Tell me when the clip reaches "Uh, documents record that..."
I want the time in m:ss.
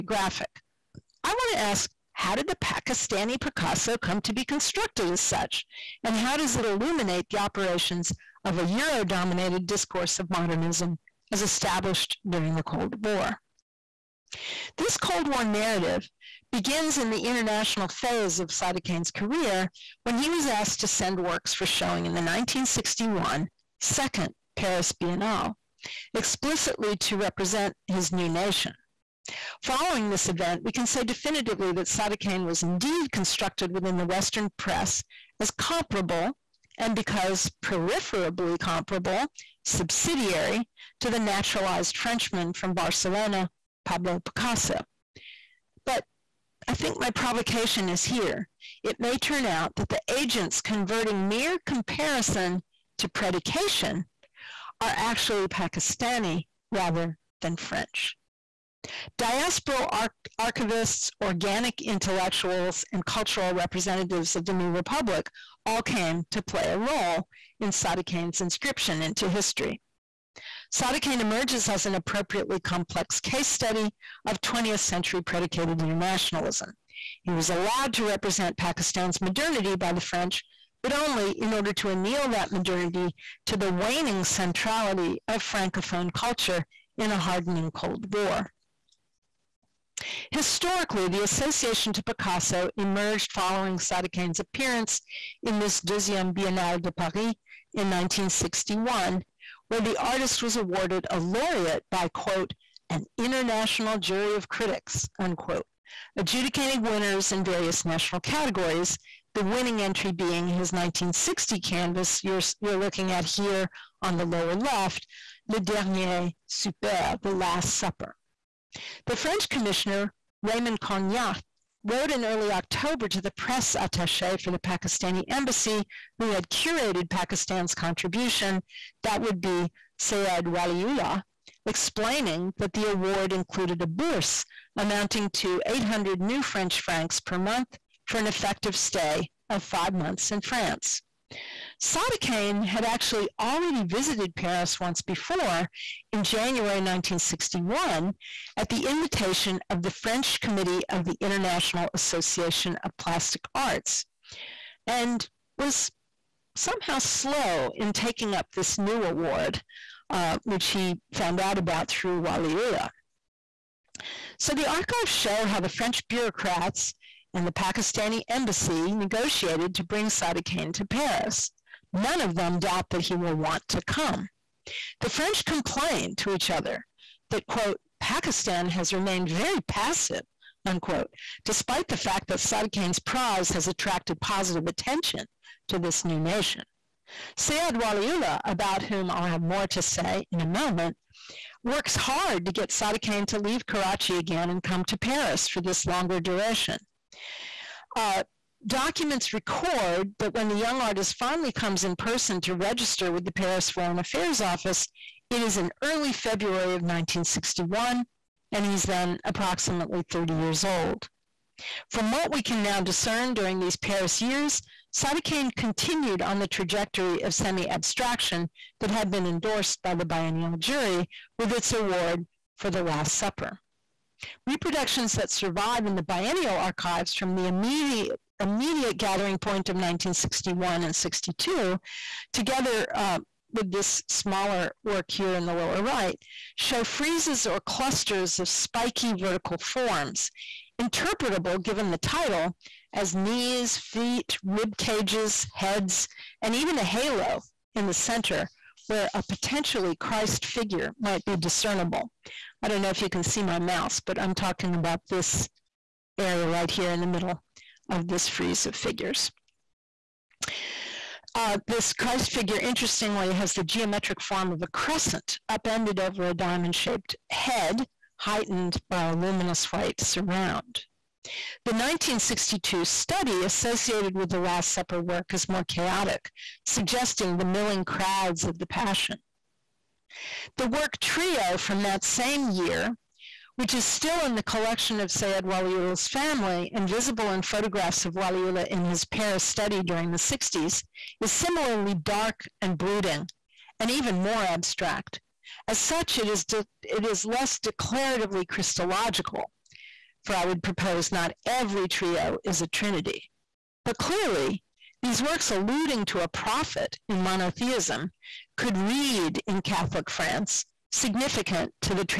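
3:17.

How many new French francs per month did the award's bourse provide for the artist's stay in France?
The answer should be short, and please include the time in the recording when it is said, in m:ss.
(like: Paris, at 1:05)
800, at 2:15.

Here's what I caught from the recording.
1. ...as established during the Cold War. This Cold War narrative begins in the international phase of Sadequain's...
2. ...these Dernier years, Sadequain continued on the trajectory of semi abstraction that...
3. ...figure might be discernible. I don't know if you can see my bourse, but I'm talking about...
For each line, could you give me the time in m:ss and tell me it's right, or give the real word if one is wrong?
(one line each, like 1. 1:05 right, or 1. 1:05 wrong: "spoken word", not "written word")
1. 0:11 right
2. 3:33 wrong: "Paris", not "Dernier"
3. 4:10 wrong: "mouse", not "bourse".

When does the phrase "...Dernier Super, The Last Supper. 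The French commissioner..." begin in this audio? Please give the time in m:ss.
1:55.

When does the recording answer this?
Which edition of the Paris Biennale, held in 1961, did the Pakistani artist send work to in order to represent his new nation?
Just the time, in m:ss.
0:23.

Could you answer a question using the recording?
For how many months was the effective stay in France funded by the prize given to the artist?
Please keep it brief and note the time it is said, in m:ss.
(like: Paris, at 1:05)
5, at 2:19.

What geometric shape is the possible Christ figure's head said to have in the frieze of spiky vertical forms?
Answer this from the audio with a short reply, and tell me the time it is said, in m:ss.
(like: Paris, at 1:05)
Diamond, at 4:26.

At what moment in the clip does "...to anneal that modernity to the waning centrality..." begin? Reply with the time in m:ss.
1:21.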